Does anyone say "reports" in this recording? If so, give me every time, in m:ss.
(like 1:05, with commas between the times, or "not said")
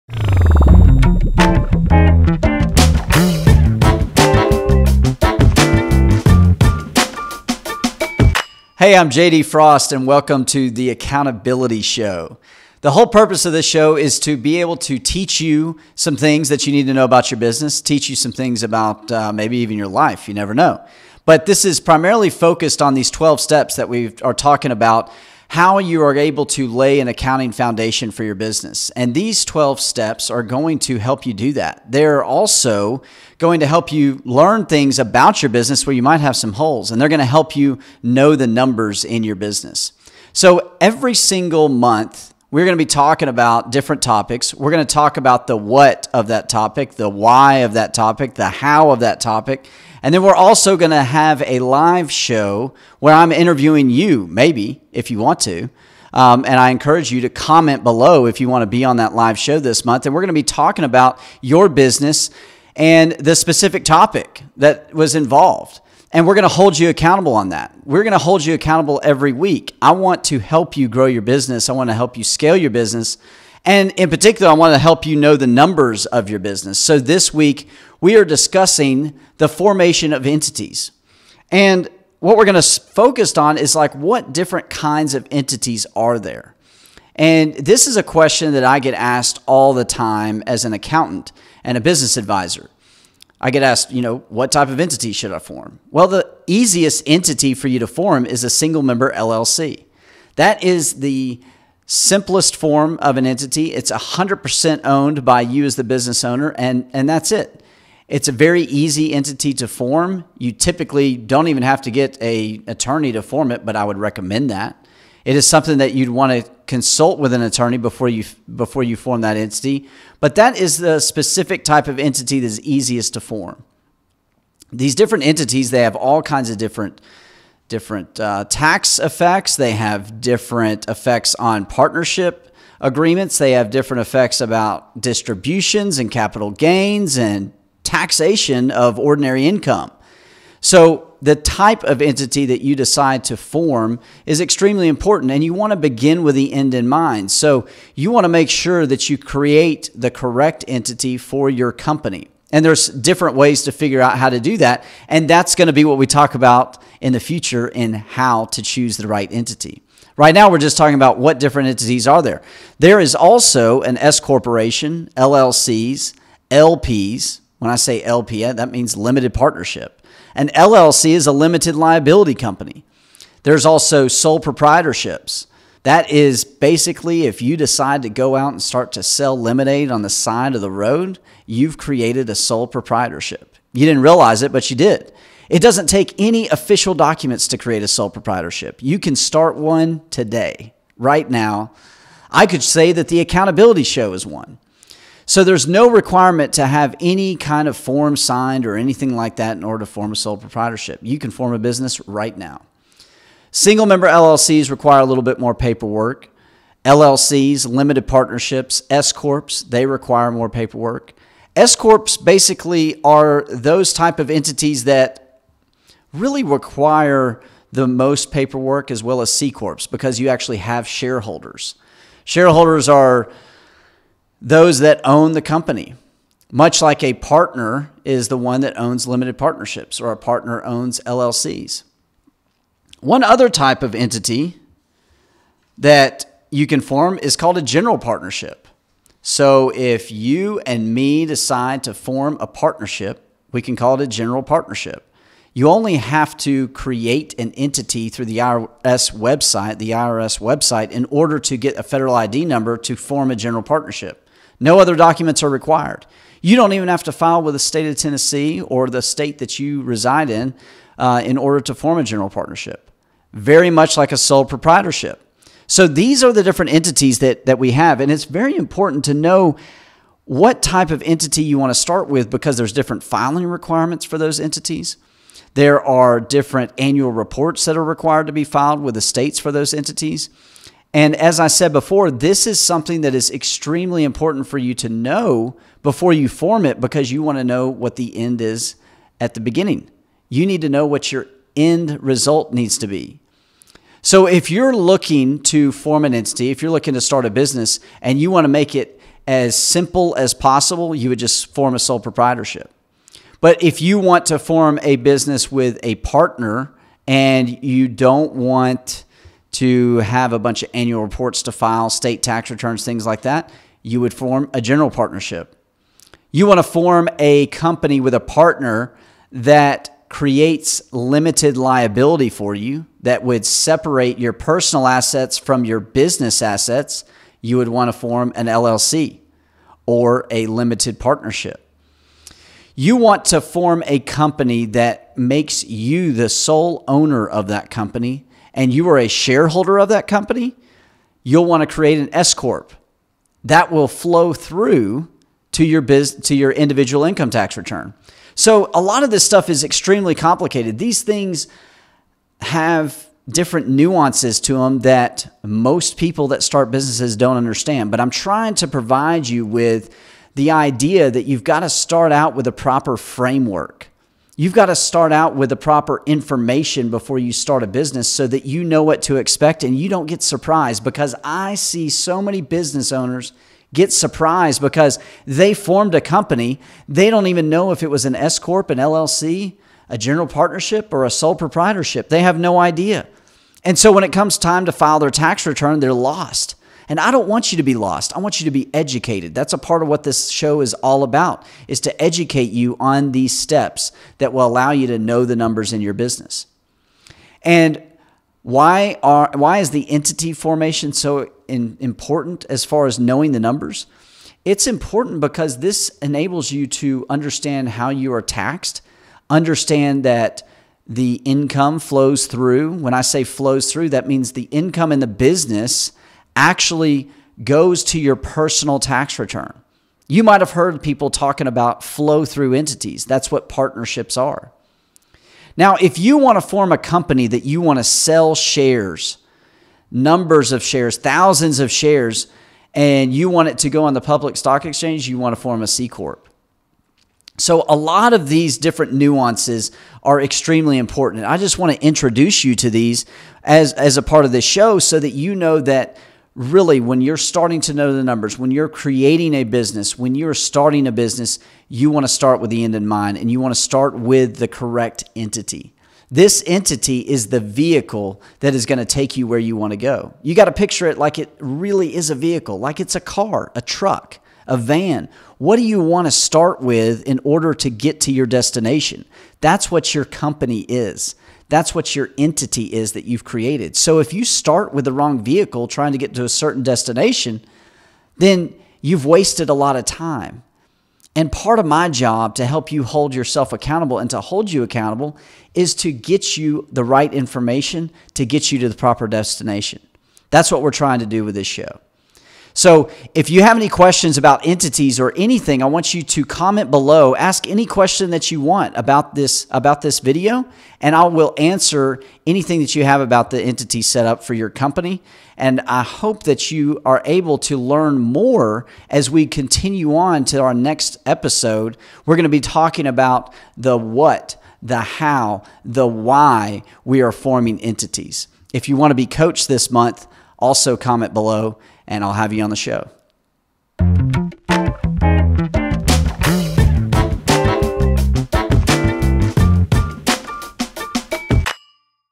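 4:37, 5:11.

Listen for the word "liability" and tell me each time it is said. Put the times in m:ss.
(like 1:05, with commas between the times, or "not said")
2:51, 5:21.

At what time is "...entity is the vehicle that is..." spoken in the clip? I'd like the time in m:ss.
7:36.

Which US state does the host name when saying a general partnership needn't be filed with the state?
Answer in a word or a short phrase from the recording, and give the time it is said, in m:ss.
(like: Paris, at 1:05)
Tennessee, at 4:17.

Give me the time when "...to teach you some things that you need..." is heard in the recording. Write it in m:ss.
0:14.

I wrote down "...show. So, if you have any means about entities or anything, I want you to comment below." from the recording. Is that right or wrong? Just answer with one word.
wrong.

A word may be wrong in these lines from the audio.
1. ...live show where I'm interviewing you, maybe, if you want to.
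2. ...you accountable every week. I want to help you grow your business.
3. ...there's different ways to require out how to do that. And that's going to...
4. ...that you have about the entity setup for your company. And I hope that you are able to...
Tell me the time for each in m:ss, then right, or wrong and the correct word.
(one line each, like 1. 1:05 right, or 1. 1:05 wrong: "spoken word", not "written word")
1. 0:51 right
2. 1:08 right
3. 2:32 wrong: "figure", not "require"
4. 8:22 right.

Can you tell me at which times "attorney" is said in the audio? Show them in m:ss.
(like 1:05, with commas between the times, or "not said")
1:52, 1:57.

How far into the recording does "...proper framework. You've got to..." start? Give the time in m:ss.
6:02.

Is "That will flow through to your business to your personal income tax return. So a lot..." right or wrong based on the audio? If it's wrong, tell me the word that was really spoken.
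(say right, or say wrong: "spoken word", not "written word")
wrong: "individual", not "personal".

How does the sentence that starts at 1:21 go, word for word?
And what we're going to focus on is like what different kinds of entities are there?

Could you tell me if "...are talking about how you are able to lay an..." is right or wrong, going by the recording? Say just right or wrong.
right.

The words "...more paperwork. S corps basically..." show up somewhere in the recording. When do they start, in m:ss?
3:30.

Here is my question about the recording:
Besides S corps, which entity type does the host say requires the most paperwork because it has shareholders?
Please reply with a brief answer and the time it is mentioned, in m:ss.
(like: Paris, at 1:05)
C corps, at 3:39.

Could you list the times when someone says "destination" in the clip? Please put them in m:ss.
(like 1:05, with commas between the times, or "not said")
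7:48, 7:56, 8:09.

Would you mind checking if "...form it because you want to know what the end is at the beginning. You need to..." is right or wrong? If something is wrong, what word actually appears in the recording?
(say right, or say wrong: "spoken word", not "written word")
right.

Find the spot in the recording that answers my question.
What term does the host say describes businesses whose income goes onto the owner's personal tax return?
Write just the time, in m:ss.
7:01.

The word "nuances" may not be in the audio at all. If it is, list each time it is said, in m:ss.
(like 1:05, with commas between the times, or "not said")
5:53, 7:18.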